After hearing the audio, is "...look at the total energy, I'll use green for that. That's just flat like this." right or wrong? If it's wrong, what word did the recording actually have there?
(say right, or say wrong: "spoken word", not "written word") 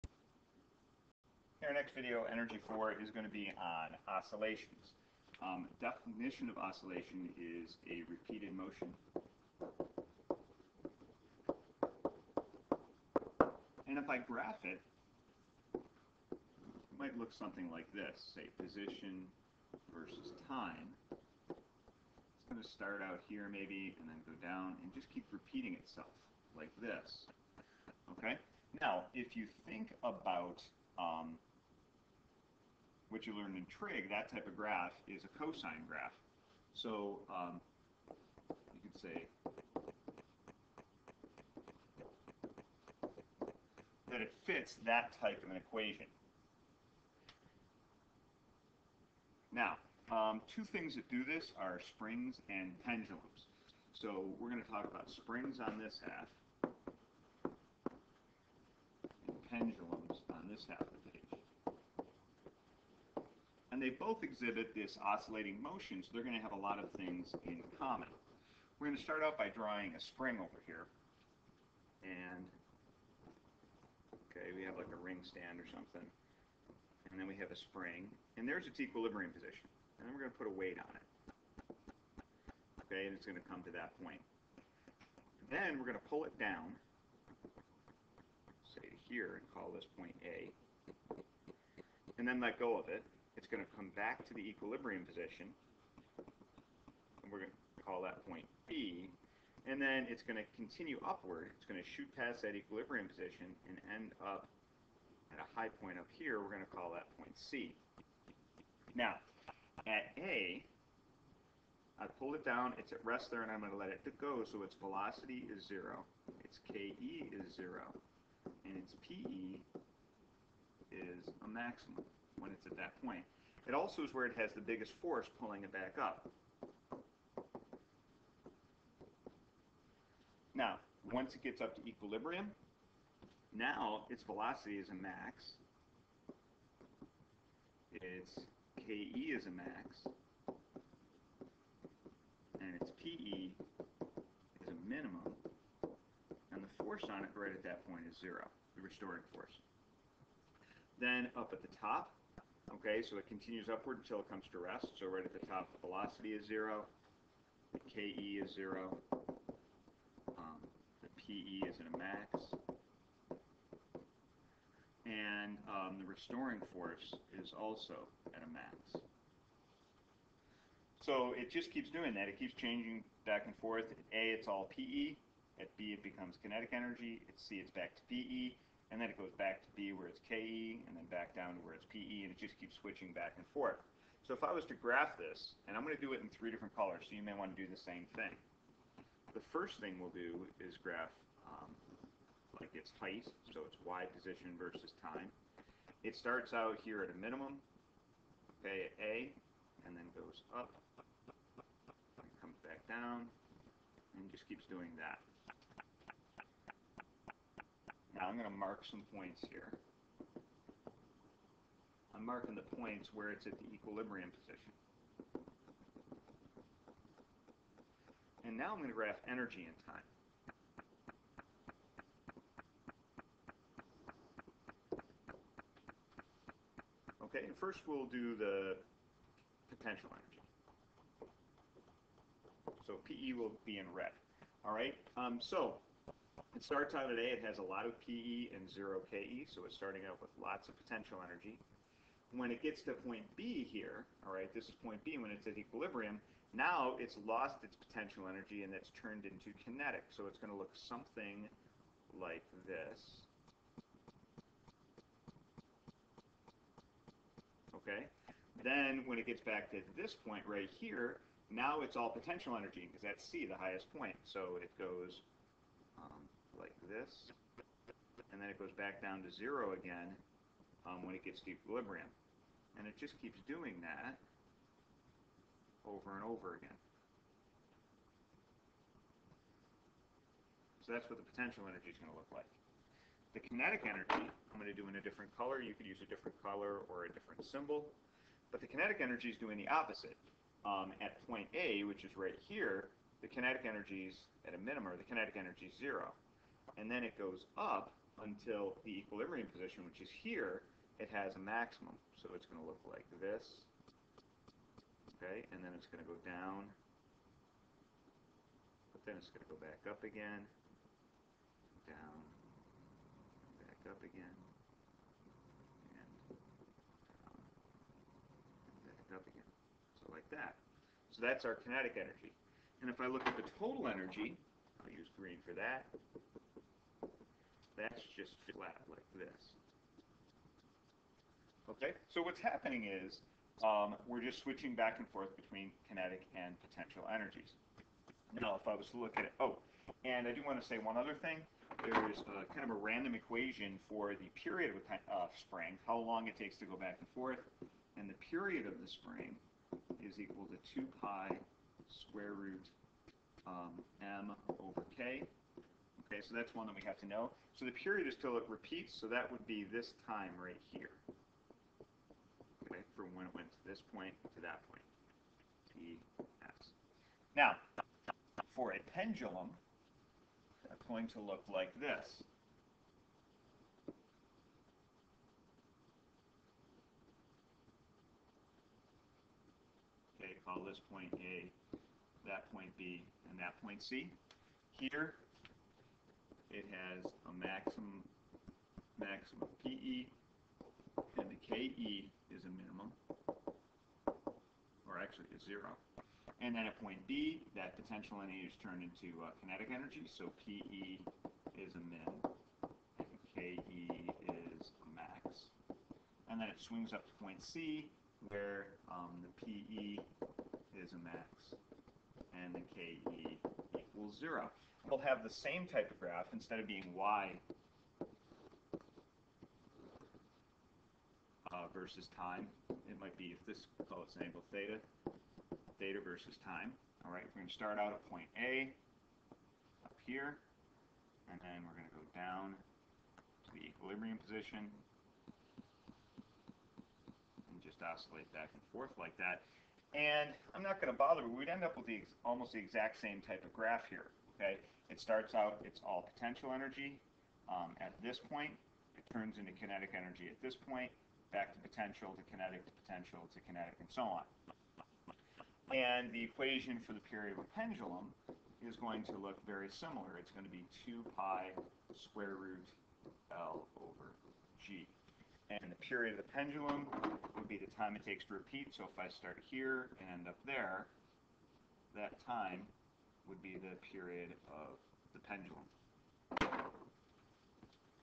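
right.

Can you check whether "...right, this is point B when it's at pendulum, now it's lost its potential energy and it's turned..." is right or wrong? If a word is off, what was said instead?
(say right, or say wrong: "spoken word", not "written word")
wrong: "equilibrium", not "pendulum".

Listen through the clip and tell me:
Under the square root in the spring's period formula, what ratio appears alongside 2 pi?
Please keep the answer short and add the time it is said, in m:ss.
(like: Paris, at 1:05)
m over k, at 5:54.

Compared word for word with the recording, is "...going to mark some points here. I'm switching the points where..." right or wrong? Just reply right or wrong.
wrong.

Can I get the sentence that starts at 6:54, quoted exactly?
We'll have the same type of graph.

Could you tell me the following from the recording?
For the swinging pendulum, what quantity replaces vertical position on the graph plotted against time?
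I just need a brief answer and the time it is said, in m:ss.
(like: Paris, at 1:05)
angle theta, at 7:04.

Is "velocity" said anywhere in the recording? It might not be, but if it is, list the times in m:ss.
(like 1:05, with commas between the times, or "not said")
1:54, 2:14, 2:35.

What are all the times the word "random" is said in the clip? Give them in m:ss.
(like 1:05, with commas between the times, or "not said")
5:42.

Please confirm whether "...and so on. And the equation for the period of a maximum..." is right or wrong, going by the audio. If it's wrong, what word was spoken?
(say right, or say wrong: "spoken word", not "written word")
wrong: "pendulum", not "maximum".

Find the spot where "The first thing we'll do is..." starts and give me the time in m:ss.
3:09.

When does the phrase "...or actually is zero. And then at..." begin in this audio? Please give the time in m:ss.
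6:34.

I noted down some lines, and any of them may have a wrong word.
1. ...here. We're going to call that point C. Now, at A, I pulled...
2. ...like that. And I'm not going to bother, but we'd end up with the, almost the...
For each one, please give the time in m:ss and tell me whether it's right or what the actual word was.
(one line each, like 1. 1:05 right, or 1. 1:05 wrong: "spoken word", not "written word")
1. 1:46 right
2. 7:18 right.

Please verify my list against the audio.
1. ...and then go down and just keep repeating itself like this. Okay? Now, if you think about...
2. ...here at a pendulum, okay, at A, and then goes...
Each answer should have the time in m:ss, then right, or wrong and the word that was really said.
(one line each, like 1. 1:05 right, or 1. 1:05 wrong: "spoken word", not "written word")
1. 0:24 right
2. 3:16 wrong: "minimum", not "pendulum".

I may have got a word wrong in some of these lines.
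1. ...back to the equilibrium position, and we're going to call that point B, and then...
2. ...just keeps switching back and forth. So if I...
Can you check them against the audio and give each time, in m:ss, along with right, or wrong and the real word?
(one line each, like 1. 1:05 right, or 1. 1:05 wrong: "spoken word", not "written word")
1. 1:33 right
2. 3:02 right.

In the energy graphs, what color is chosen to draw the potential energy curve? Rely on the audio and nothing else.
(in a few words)
red.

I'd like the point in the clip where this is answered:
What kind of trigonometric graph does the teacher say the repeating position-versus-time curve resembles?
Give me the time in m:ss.
0:35.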